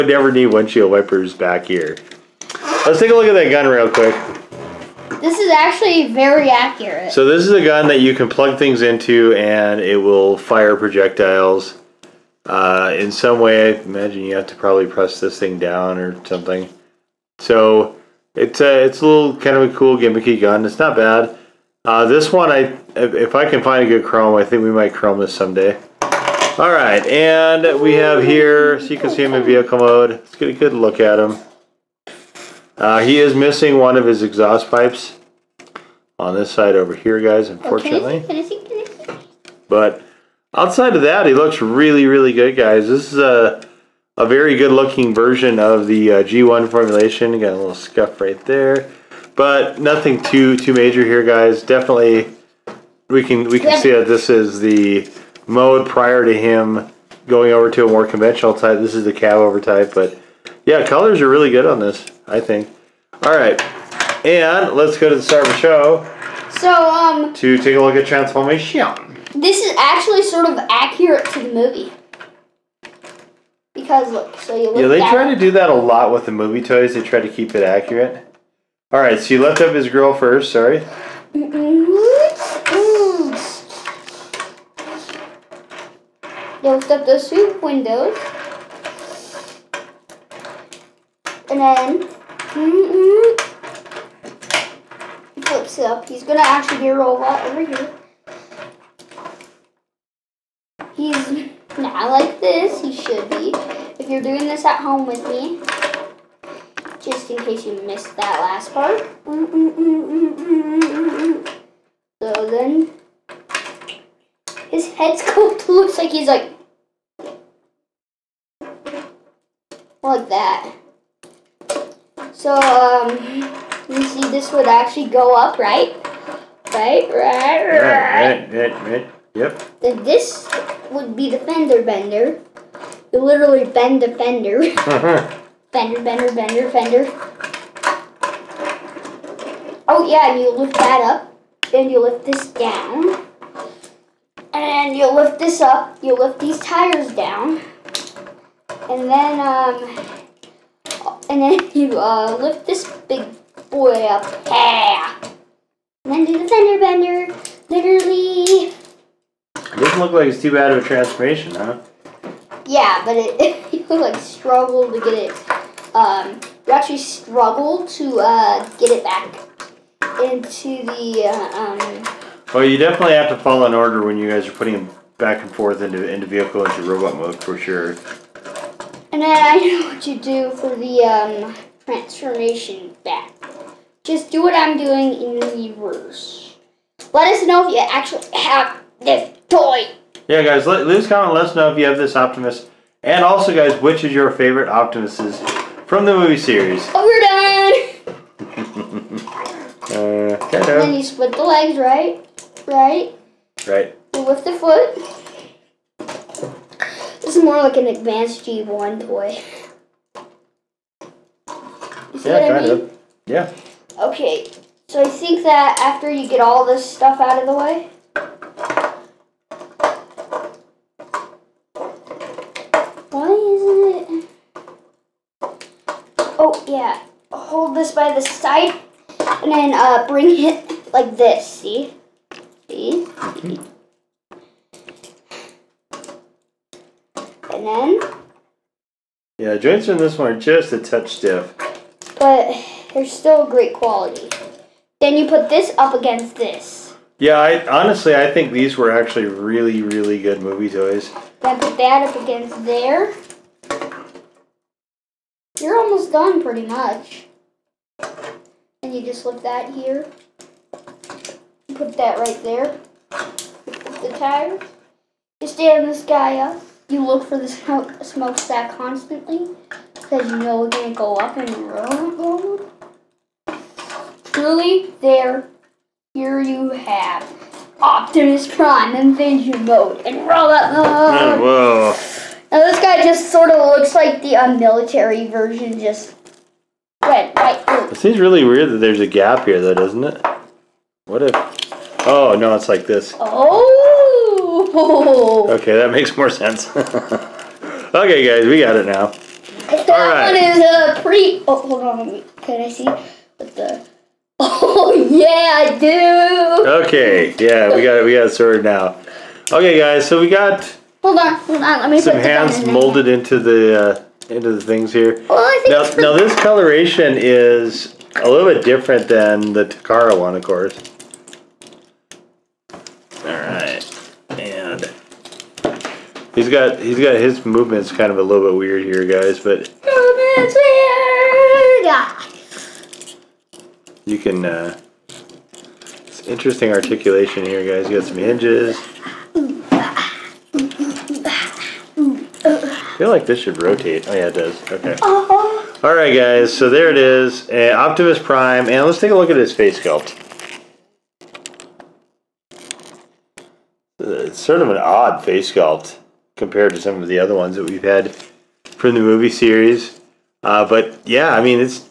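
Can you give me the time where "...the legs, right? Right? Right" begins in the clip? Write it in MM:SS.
03:21.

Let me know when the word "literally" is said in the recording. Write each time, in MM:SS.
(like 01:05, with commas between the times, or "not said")
02:13, 02:37.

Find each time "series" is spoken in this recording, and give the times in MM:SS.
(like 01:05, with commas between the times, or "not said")
03:16, 05:59.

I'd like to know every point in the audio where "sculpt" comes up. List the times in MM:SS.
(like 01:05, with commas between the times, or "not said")
05:49, 05:55.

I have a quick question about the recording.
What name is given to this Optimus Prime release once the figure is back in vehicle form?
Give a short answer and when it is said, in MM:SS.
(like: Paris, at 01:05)
Evasion Mode, at 04:38.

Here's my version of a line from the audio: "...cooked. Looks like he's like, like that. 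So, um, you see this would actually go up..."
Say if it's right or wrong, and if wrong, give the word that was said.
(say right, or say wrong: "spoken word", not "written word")
right.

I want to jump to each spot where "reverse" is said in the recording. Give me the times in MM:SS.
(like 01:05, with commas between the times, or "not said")
03:05.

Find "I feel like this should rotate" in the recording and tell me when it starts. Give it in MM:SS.
05:42.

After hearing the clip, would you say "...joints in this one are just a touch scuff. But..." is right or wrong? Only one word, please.
wrong.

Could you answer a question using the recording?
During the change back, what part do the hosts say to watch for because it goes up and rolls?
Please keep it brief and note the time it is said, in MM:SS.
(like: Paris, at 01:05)
Smokestack, at 04:28.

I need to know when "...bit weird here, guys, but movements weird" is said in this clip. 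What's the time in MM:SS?
05:28.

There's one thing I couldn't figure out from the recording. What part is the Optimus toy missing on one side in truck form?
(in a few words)
One of his exhaust pipes.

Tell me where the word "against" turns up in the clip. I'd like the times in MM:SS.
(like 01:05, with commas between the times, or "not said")
04:05, 04:12.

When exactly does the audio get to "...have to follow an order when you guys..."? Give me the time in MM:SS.
02:53.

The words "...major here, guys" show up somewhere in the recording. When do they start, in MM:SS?
00:50.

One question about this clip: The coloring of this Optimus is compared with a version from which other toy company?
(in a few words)
Takara.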